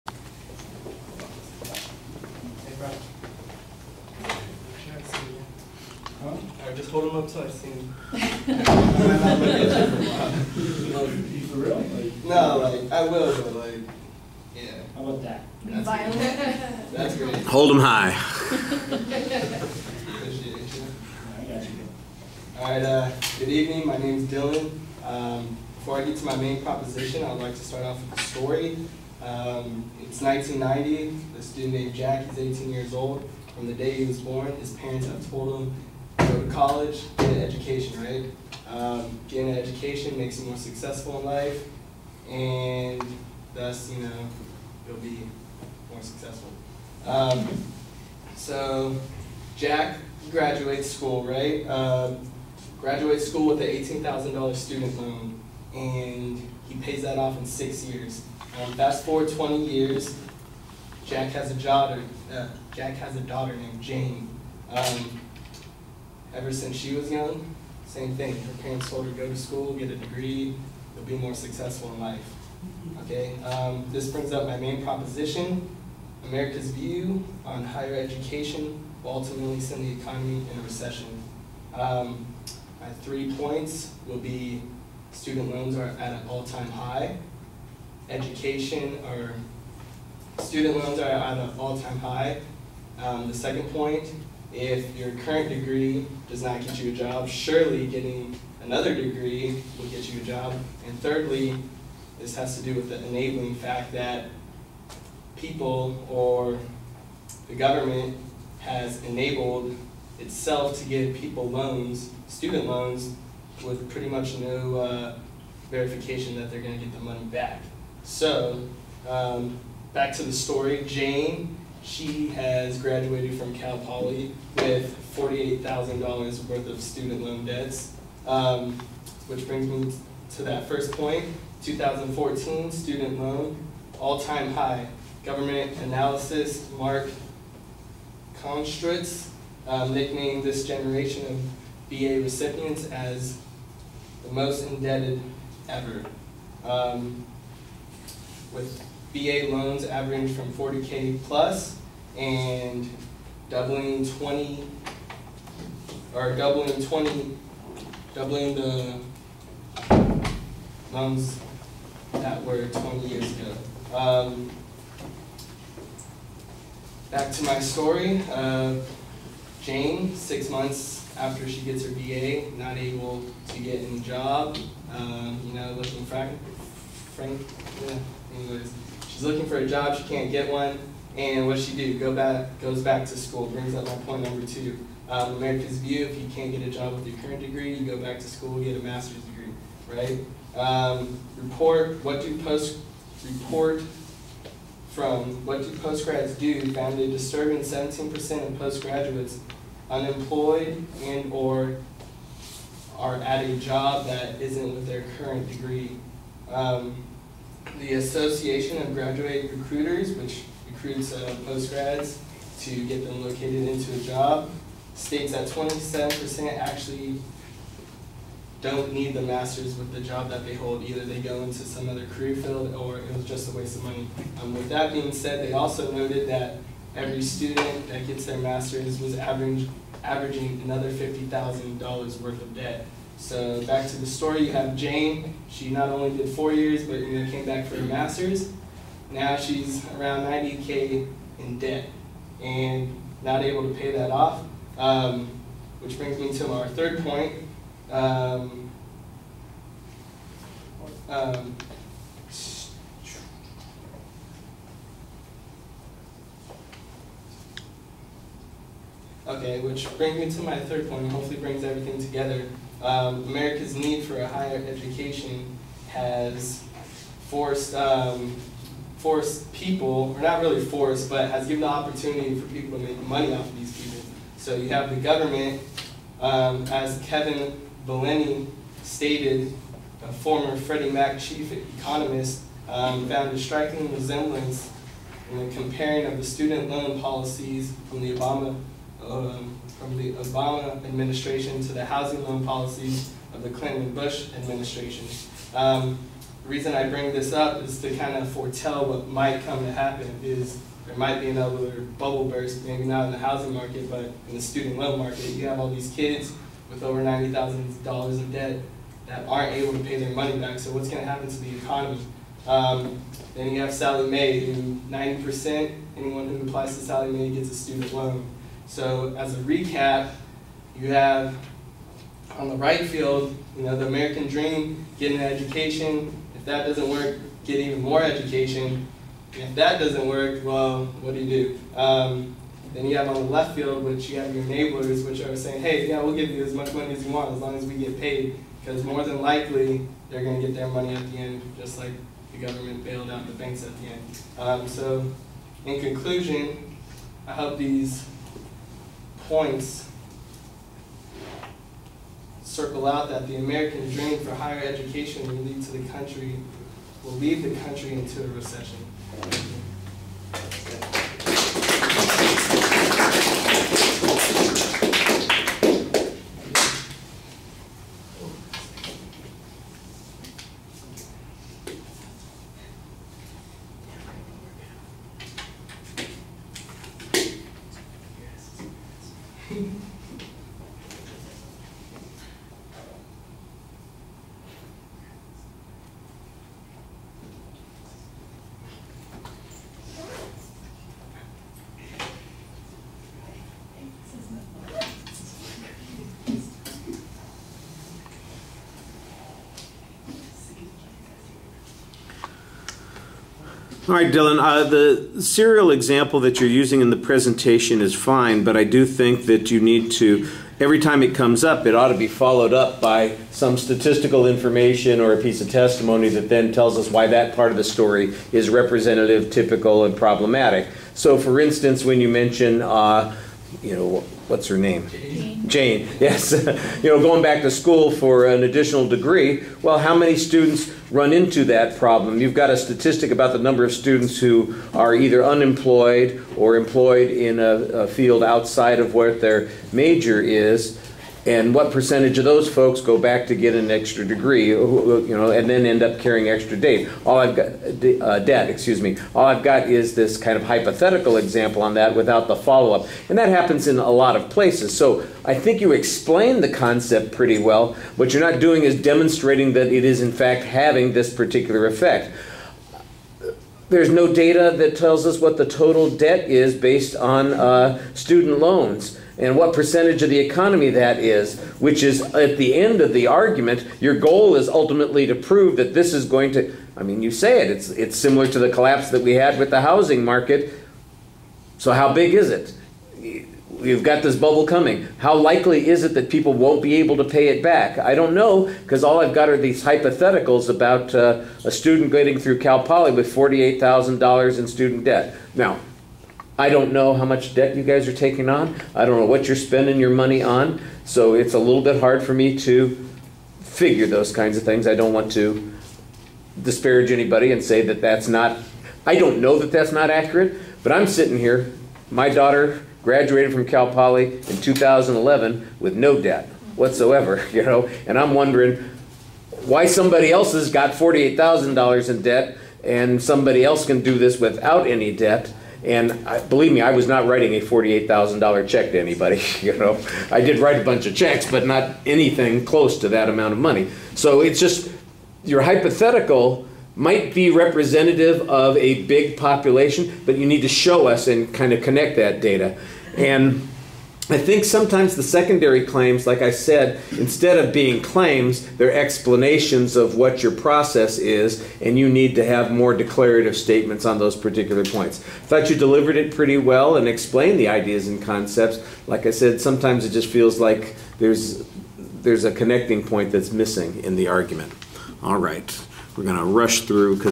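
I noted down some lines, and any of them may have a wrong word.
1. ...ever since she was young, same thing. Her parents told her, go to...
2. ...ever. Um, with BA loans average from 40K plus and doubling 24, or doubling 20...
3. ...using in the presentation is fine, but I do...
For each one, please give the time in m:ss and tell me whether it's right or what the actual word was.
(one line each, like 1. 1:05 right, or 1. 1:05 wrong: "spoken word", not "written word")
1. 1:06 right
2. 2:25 wrong: "20", not "24"
3. 6:46 right.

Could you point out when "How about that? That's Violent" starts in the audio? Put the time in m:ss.
0:14.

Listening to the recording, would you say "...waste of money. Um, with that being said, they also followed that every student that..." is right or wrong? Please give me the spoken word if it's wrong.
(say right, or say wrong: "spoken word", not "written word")
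wrong: "noted", not "followed".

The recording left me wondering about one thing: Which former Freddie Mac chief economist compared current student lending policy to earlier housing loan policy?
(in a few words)
Kevin Villani.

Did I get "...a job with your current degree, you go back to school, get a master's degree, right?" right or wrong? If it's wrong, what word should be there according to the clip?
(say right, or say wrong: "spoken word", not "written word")
right.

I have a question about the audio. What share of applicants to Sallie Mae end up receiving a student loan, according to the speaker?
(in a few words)
90%.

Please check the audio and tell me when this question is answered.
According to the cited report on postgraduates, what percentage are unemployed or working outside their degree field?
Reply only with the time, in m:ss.
3:17.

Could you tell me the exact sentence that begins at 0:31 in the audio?
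A student named Jack, is 18 years old.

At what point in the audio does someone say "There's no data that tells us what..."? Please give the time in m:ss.
7:43.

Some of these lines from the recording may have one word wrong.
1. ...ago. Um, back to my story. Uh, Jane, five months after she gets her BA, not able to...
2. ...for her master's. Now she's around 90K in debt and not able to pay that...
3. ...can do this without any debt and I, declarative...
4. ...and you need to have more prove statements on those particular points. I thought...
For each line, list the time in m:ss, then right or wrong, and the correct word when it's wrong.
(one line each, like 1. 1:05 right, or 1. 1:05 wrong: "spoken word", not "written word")
1. 2:43 wrong: "six", not "five"
2. 3:57 right
3. 8:43 wrong: "believe", not "declarative"
4. 9:11 wrong: "declarative", not "prove".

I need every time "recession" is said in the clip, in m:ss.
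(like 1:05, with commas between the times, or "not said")
1:20, 5:58.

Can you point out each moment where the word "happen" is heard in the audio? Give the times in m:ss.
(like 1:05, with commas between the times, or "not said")
4:59, 5:11, 7:33.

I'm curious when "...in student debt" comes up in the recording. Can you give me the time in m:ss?
8:14.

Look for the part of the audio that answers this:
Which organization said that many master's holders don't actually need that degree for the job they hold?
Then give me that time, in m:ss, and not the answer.
3:27.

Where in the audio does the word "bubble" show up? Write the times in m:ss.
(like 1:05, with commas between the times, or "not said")
5:01, 8:04.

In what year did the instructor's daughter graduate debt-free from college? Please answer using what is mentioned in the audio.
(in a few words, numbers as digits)
2011.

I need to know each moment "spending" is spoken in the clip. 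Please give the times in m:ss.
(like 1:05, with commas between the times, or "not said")
8:19.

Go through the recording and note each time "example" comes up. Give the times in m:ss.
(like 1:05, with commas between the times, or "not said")
6:45, 7:31.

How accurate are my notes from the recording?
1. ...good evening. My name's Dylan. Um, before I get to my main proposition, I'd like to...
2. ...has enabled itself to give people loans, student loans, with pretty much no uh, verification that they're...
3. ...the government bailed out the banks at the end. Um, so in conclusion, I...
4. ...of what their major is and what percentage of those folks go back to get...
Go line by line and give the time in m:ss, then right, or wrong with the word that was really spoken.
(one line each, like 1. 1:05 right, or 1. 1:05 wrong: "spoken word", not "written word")
1. 0:23 right
2. 1:48 right
3. 5:42 right
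4. 7:18 right.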